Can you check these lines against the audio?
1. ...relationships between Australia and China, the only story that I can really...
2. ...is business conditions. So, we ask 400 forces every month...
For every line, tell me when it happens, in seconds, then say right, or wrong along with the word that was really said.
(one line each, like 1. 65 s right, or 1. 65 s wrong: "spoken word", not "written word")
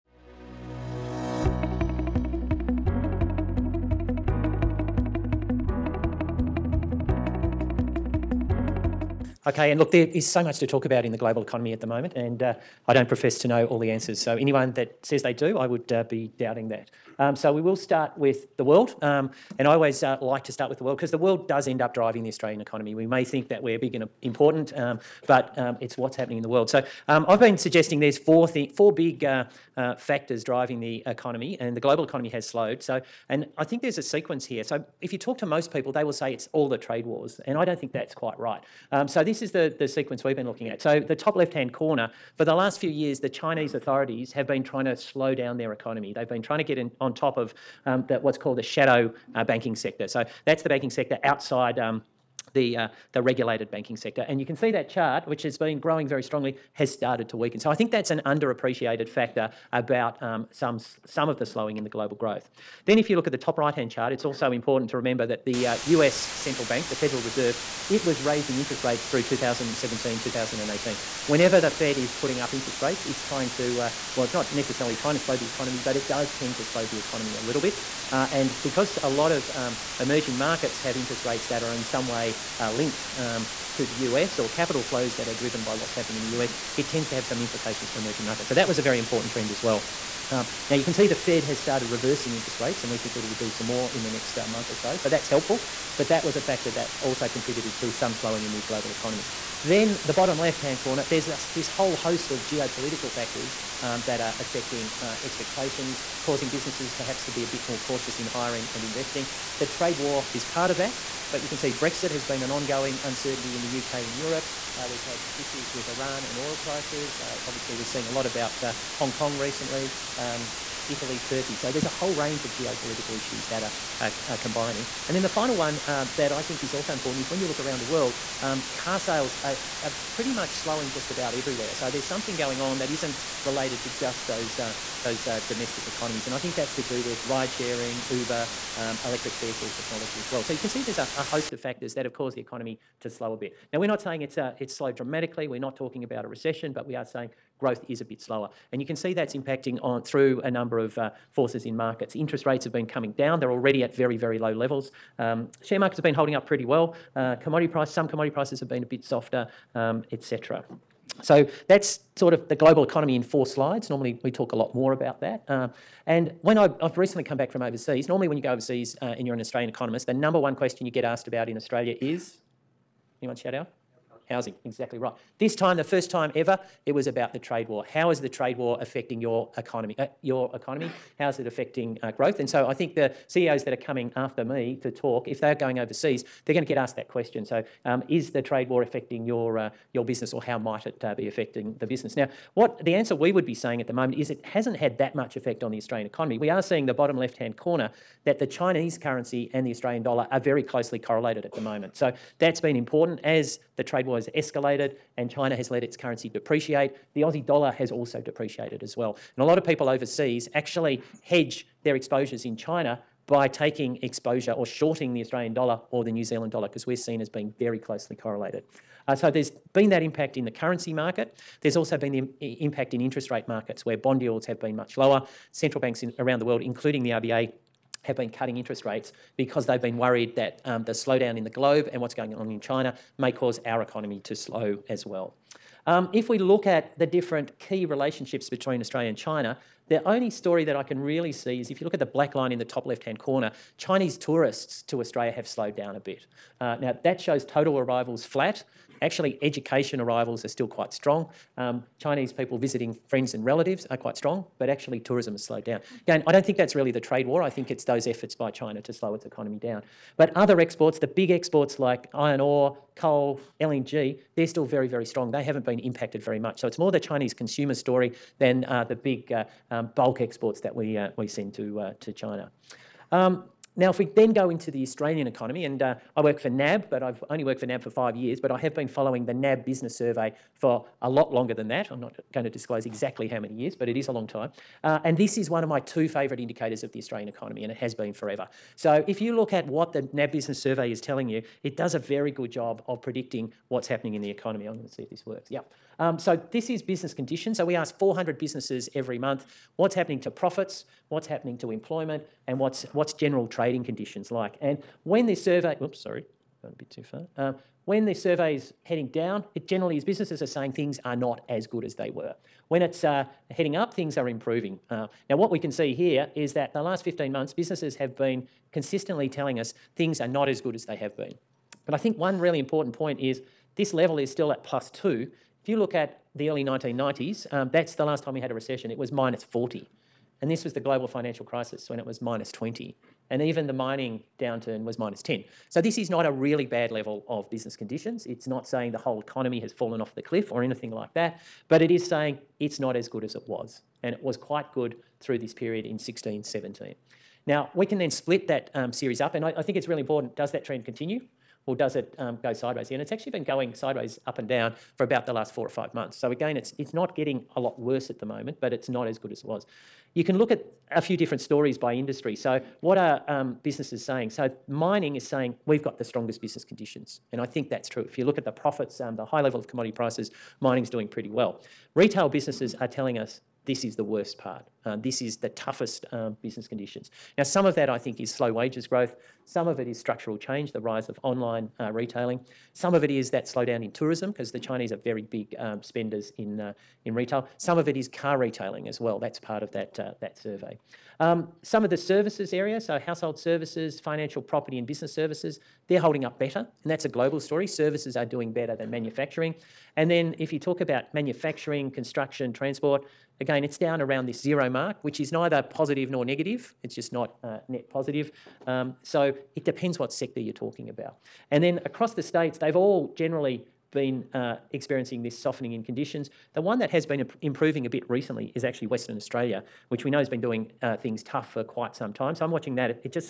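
1. 237 s right
2. 296 s wrong: "businesses", not "forces".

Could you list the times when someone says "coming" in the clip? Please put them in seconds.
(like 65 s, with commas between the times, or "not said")
152 s, 183 s.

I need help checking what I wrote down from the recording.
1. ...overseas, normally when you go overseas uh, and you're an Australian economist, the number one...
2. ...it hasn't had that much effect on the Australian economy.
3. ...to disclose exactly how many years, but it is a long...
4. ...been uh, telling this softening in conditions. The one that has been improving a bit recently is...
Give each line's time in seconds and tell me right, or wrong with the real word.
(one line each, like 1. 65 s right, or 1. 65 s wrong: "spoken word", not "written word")
1. 167 s right
2. 194 s right
3. 282 s right
4. 413 s wrong: "experiencing", not "telling".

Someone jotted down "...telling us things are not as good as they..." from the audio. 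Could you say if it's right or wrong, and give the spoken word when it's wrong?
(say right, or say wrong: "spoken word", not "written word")
right.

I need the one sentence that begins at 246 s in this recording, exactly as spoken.
Uh, now, that shows total arrivals flat.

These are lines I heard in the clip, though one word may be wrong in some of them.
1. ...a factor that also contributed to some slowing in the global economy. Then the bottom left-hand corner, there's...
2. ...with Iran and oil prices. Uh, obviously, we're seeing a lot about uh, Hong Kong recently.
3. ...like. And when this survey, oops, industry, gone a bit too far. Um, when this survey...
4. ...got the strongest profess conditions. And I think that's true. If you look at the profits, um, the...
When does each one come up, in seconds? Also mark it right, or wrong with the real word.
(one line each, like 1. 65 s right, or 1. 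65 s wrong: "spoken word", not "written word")
1. 96 s right
2. 115 s right
3. 304 s wrong: "sorry", not "industry"
4. 365 s wrong: "business", not "profess".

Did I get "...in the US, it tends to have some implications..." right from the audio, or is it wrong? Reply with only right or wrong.
right.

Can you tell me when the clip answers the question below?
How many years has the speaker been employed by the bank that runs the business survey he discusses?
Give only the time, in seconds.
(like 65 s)
277 s.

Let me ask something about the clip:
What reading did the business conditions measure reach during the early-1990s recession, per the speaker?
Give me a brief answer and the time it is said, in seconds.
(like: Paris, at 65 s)
-40, at 329 s.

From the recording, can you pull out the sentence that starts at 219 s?
Uh, so there's been that impact in the currency market.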